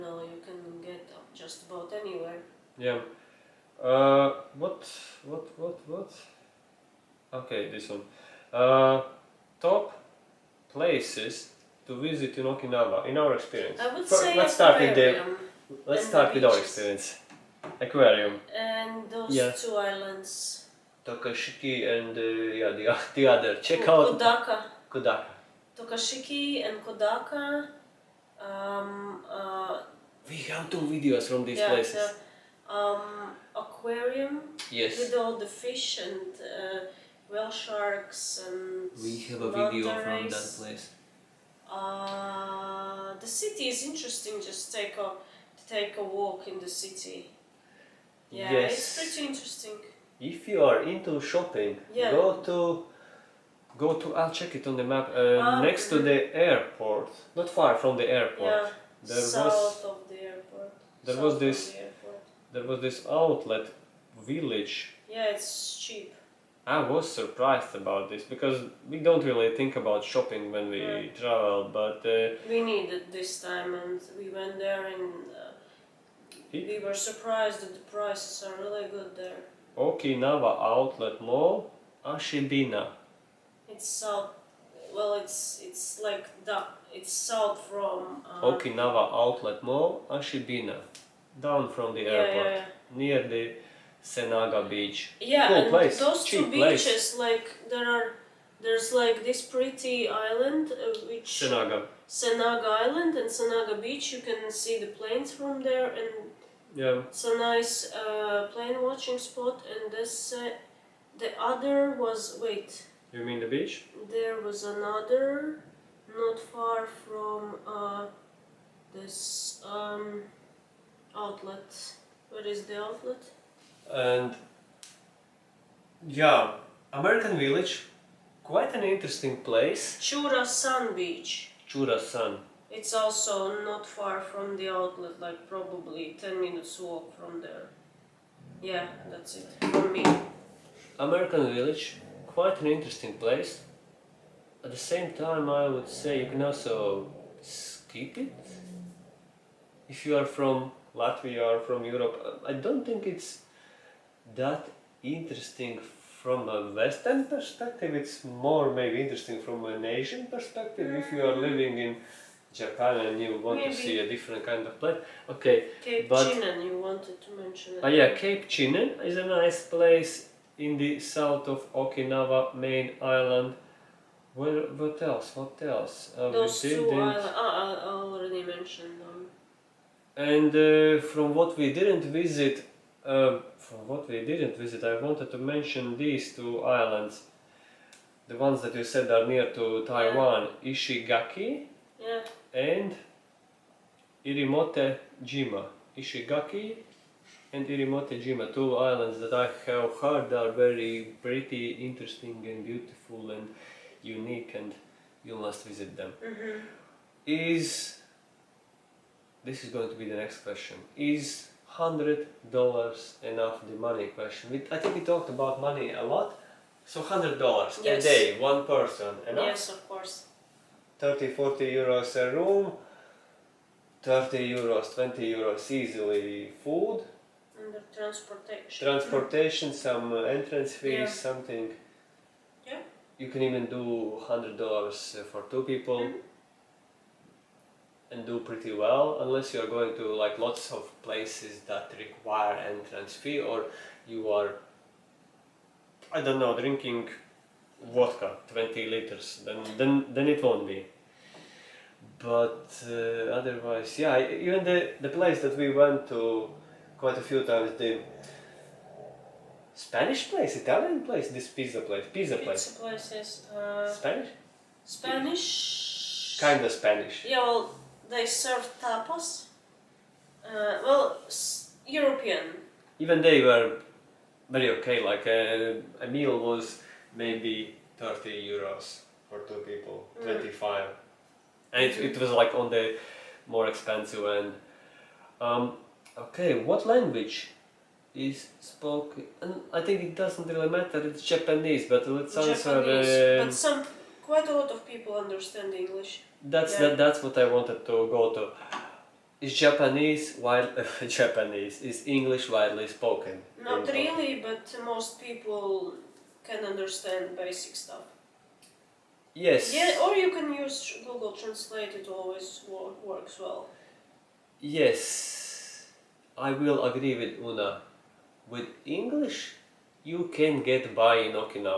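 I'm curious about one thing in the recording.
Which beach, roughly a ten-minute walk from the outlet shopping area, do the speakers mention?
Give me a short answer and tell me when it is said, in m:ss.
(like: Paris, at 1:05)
Chura Sun Beach, at 2:10.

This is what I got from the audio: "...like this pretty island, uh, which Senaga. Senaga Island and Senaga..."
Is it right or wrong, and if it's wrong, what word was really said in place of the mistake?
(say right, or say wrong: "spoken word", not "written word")
right.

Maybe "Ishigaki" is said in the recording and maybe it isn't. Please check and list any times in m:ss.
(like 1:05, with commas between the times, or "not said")
3:10, 3:15.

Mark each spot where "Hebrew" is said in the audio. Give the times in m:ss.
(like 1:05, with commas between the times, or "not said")
not said.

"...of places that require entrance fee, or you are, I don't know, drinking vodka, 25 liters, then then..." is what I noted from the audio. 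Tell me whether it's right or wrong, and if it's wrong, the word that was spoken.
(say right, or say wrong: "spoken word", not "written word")
wrong: "20", not "25".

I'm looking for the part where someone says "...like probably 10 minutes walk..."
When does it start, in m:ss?
2:15.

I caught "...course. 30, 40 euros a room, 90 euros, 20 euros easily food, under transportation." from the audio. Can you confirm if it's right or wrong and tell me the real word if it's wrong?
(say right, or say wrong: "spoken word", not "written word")
wrong: "30", not "90".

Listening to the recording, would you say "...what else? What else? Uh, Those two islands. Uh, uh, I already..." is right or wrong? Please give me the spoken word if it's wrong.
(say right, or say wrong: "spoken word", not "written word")
right.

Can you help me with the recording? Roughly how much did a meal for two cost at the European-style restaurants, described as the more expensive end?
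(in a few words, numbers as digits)
30 euros.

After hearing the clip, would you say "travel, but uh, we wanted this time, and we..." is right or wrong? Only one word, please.
wrong.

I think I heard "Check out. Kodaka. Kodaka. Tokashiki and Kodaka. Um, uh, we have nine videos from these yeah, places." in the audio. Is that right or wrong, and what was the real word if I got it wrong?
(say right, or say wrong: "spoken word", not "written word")
wrong: "two", not "nine".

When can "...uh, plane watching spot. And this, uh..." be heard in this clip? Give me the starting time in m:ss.
1:47.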